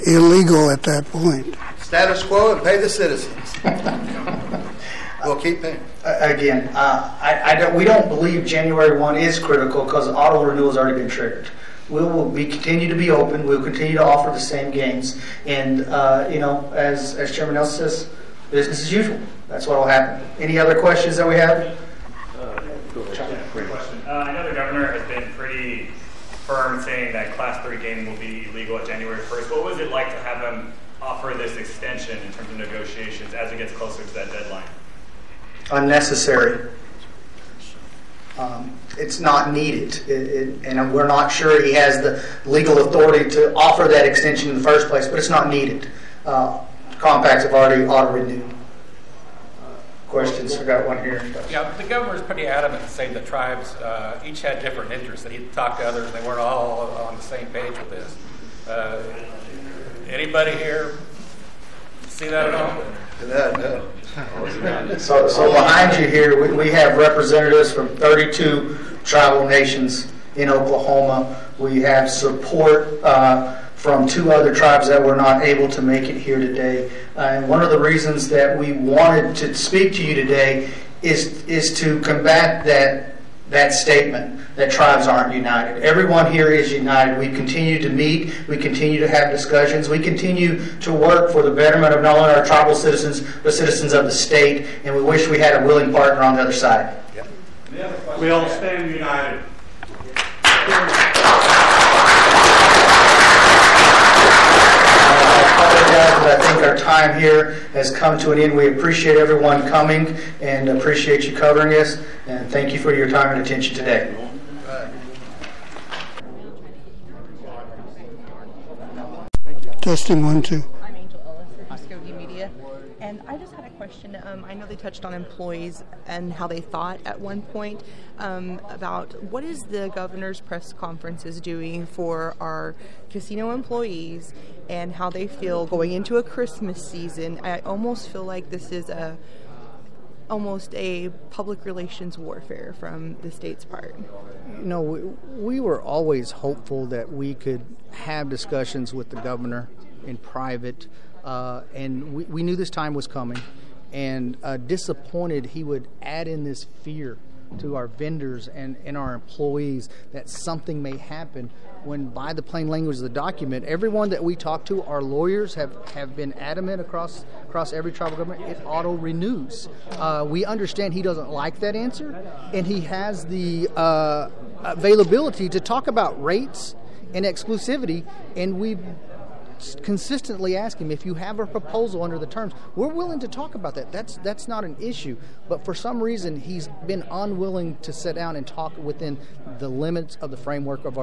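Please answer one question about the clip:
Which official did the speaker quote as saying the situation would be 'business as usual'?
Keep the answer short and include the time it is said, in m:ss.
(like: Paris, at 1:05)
Chairman Nelson, at 0:17.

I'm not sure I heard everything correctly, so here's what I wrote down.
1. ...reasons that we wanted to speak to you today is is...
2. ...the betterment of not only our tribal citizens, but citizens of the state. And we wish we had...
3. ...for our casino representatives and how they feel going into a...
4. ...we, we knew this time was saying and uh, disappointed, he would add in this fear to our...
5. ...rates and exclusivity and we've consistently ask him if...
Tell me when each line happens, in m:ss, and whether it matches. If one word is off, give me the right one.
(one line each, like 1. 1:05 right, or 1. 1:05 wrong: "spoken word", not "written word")
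1. 1:17 right
2. 1:31 right
3. 2:11 wrong: "employees", not "representatives"
4. 2:32 wrong: "coming", not "saying"
5. 2:56 right.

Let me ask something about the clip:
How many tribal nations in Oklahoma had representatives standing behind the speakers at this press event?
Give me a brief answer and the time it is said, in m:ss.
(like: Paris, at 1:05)
32, at 1:07.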